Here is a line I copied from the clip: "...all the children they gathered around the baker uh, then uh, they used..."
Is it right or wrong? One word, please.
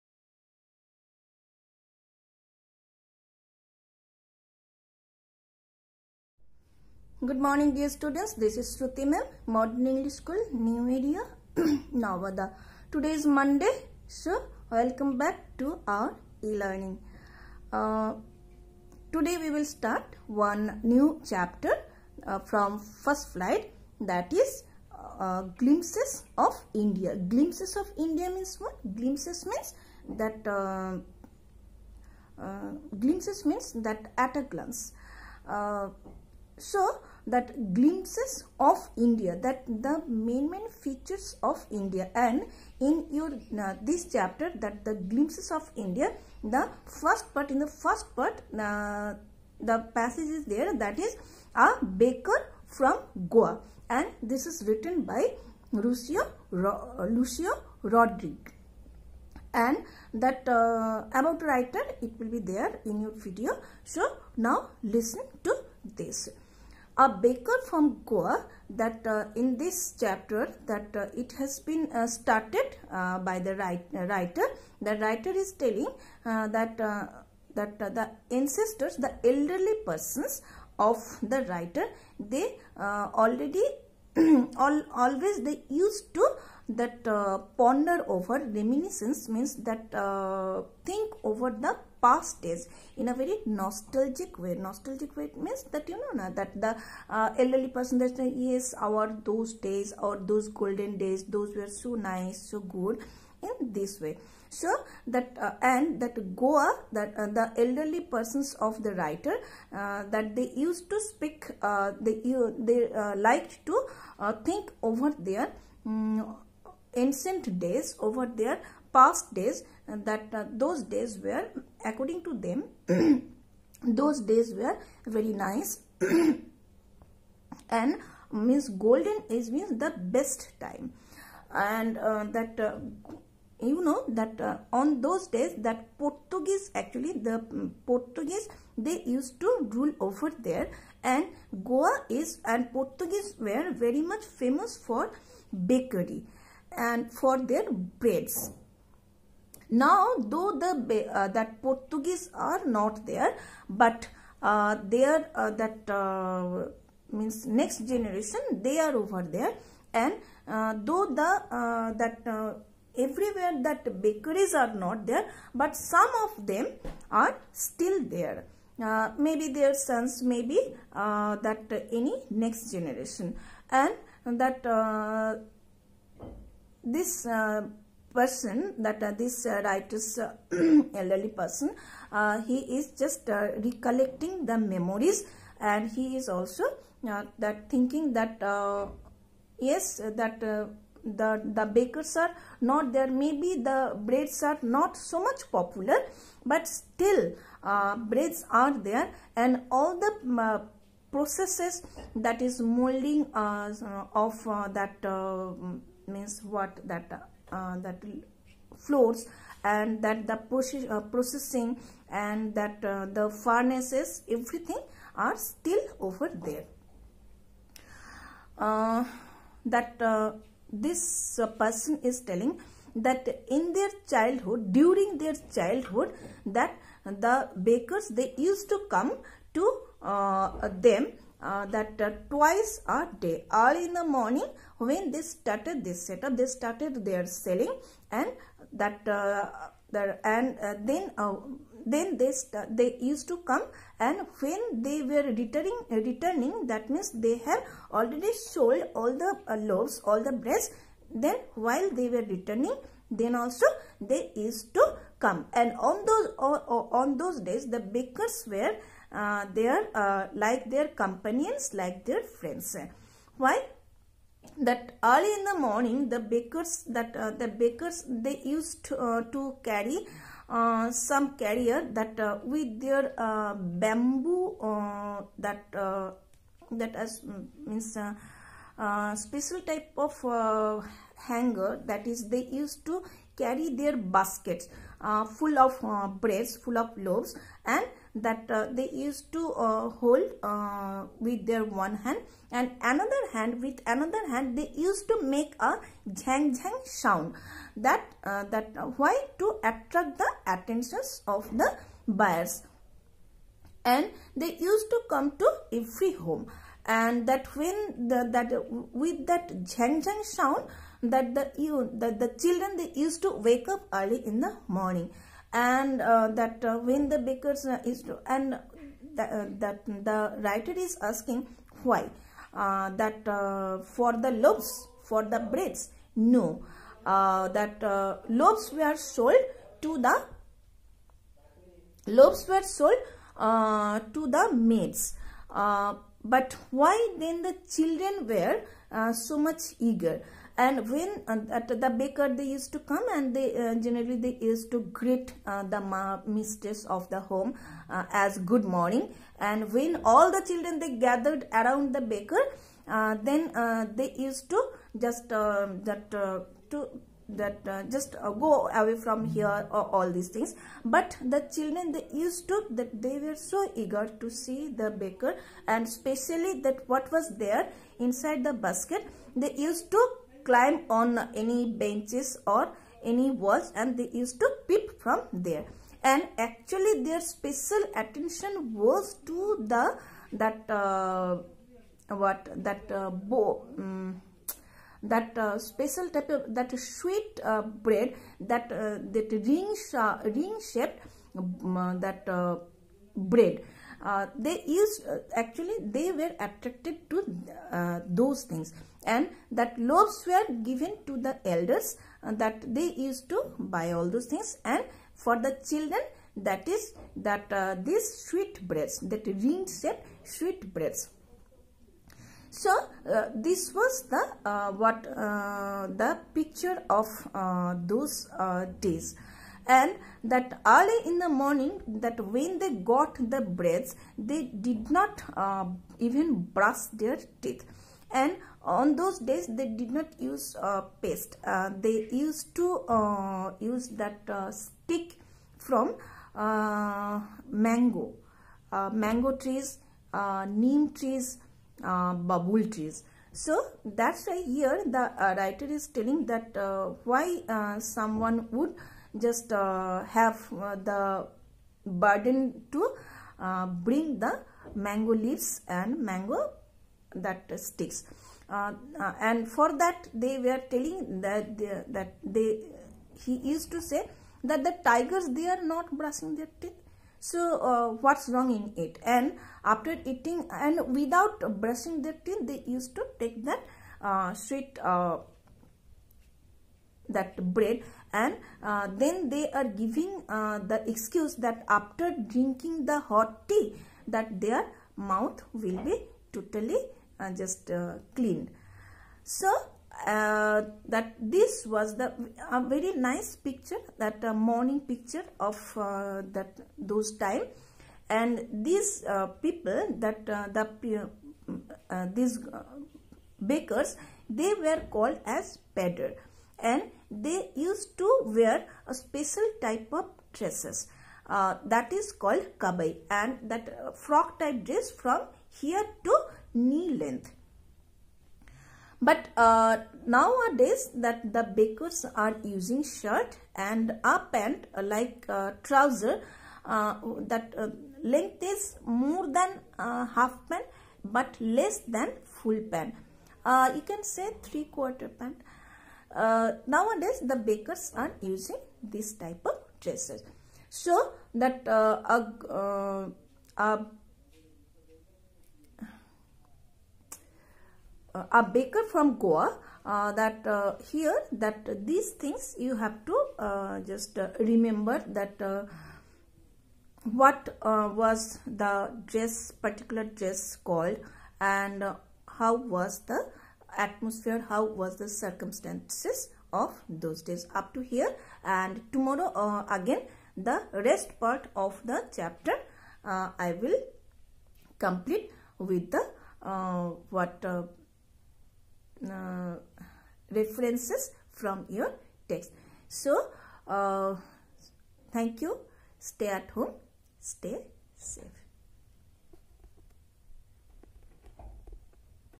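right.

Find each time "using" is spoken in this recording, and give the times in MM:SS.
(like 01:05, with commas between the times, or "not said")
08:42, 08:58.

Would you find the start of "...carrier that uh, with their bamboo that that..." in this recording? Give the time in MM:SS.
04:31.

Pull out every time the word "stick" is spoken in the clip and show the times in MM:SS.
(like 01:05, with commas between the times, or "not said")
07:14, 07:37.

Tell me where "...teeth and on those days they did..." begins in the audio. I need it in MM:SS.
07:07.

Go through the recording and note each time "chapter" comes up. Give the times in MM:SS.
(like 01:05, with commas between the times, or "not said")
00:21, 00:44, 01:09, 09:32.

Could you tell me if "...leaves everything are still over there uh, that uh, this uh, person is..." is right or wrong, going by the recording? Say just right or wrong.
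wrong.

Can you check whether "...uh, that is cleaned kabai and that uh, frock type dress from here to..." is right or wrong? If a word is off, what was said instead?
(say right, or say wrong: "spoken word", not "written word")
wrong: "called", not "cleaned".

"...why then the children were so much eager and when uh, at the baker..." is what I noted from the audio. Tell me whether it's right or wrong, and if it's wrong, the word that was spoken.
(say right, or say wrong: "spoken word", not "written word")
right.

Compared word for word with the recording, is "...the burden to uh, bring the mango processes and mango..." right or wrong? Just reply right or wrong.
wrong.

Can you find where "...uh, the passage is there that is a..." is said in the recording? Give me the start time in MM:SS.
00:48.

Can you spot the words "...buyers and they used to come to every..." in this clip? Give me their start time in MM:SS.
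05:02.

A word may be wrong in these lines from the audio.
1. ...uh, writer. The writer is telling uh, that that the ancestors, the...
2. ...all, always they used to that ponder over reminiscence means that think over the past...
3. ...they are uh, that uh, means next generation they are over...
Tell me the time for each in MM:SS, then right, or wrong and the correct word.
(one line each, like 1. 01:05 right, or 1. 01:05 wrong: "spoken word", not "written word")
1. 01:13 right
2. 01:24 right
3. 02:34 right.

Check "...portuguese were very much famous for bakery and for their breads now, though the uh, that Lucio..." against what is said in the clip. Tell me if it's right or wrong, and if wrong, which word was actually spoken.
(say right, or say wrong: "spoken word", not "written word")
wrong: "Portuguese", not "Lucio".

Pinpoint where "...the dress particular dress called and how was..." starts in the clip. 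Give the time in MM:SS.
09:18.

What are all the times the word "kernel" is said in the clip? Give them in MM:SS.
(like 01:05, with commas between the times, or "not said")
not said.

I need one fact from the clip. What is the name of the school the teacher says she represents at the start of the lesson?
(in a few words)
Modern English School.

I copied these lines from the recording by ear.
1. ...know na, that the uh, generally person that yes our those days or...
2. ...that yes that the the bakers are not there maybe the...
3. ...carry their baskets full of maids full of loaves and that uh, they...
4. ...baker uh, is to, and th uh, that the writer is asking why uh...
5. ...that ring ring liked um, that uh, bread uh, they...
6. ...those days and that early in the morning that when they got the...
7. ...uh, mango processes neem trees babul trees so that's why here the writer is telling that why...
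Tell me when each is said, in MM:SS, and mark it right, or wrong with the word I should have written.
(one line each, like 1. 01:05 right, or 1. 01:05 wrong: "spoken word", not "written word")
1. 01:36 wrong: "elderly", not "generally"
2. 03:08 right
3. 04:43 wrong: "breads", not "maids"
4. 05:17 right
5. 06:29 wrong: "shaped", not "liked"
6. 06:57 right
7. 07:18 wrong: "trees", not "processes".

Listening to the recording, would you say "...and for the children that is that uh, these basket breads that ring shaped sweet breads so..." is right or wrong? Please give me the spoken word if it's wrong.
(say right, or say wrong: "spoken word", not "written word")
wrong: "sweet", not "basket".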